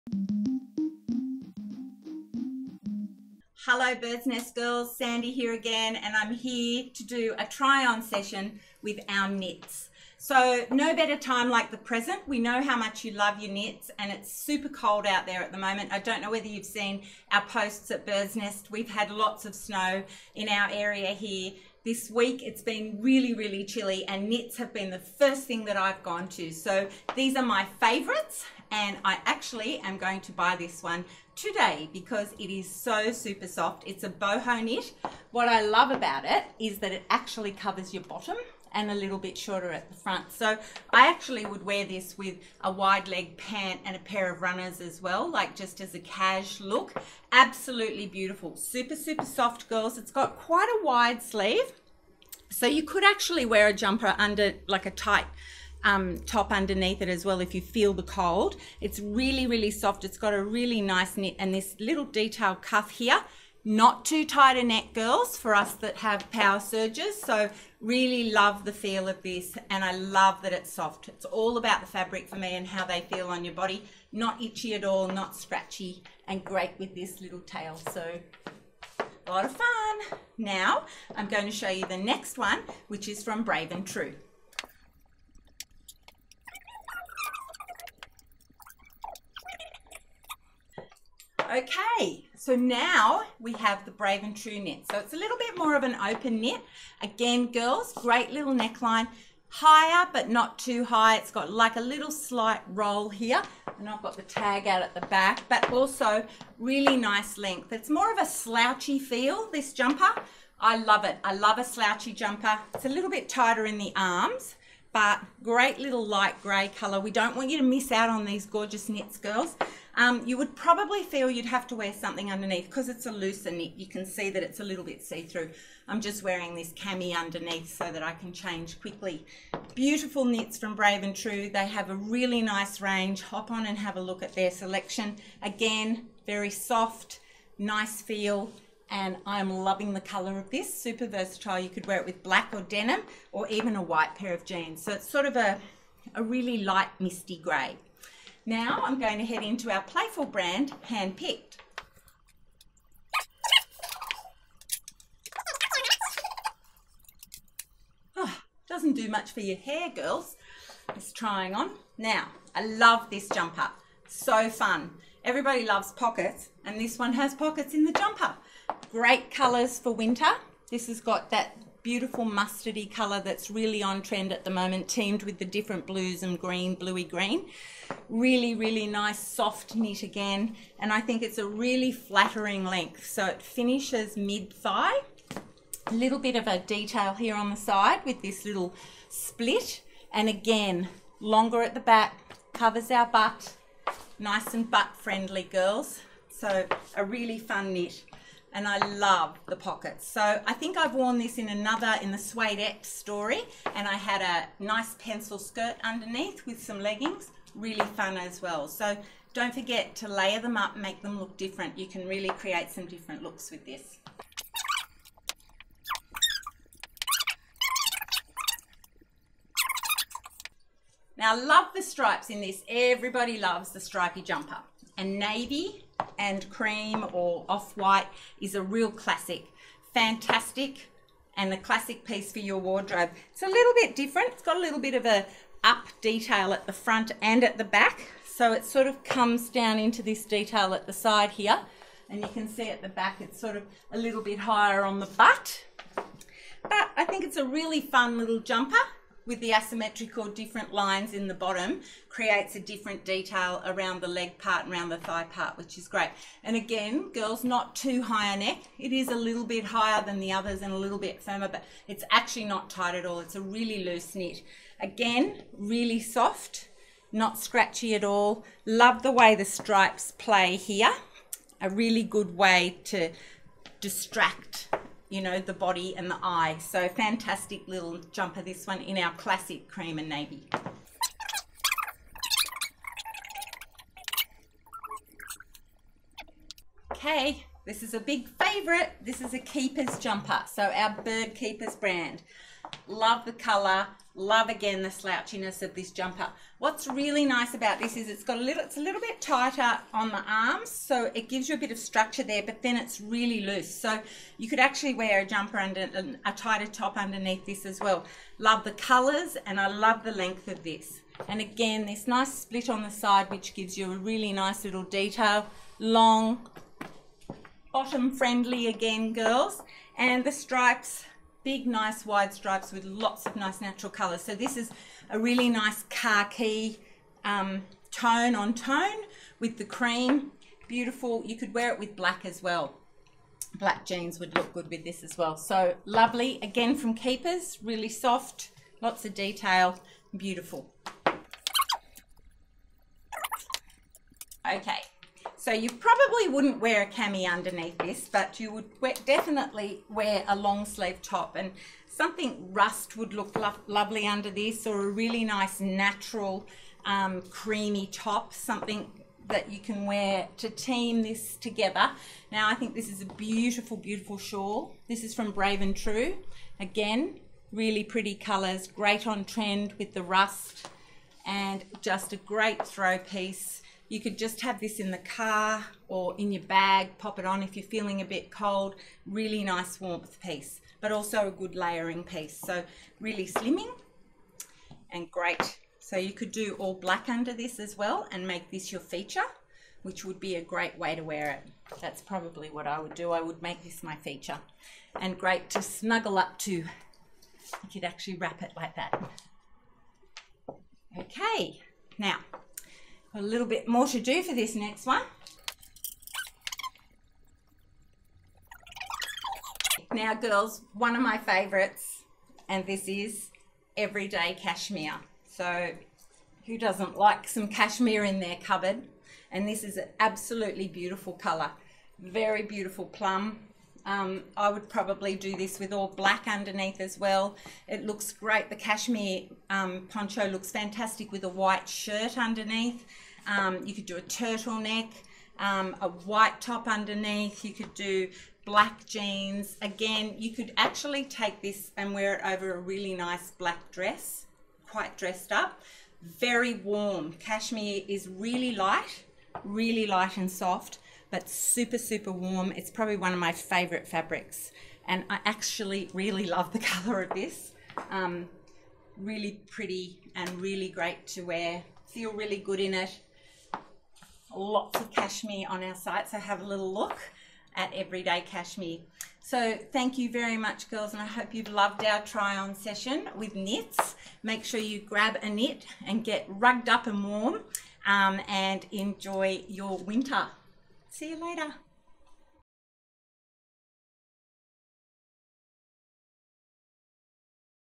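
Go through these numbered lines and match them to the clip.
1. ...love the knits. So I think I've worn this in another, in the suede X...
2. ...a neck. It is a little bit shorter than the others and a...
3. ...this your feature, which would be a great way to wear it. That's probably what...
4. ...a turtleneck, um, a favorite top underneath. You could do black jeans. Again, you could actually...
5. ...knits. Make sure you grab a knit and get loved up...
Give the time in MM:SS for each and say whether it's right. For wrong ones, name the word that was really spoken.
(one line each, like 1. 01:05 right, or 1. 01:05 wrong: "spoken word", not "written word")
1. 03:18 wrong: "pockets", not "knits"
2. 04:18 wrong: "higher", not "shorter"
3. 06:28 right
4. 07:13 wrong: "white", not "favorite"
5. 07:53 wrong: "rugged", not "loved".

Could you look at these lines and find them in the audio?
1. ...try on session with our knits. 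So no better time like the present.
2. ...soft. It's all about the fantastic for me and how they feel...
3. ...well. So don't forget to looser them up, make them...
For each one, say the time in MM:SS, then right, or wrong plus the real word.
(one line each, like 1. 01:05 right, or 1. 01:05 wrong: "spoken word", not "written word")
1. 00:07 right
2. 01:10 wrong: "fabric", not "fantastic"
3. 03:28 wrong: "layer", not "looser".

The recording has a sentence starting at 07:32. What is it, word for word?
It's probably one of my favorite fabrics.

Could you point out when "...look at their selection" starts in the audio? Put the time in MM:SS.
02:14.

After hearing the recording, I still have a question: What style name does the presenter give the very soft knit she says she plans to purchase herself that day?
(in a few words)
Boho knit.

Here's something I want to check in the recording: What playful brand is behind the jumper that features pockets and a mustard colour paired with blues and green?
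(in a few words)
Handpicked.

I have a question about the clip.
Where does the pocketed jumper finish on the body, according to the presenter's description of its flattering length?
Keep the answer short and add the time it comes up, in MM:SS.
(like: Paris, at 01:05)
Mid-thigh, at 03:04.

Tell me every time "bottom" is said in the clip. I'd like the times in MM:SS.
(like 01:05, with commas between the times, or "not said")
00:38, 04:11, 05:17.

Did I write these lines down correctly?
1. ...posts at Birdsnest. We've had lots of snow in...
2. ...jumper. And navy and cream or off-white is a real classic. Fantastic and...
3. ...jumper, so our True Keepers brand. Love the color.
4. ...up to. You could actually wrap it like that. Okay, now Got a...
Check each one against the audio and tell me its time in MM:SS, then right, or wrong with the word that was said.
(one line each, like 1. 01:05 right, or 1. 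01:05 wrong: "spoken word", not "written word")
1. 00:17 right
2. 03:44 right
3. 04:49 wrong: "Bird", not "True"
4. 06:36 right.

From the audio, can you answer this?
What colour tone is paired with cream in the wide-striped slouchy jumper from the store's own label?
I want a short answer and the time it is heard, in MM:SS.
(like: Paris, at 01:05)
Khaki, at 05:25.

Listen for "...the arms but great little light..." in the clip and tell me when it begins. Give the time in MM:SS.
01:53.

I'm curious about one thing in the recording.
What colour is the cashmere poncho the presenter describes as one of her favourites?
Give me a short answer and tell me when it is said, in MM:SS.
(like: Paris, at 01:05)
Plum, at 07:02.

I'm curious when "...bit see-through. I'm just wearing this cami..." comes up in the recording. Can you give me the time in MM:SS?
02:04.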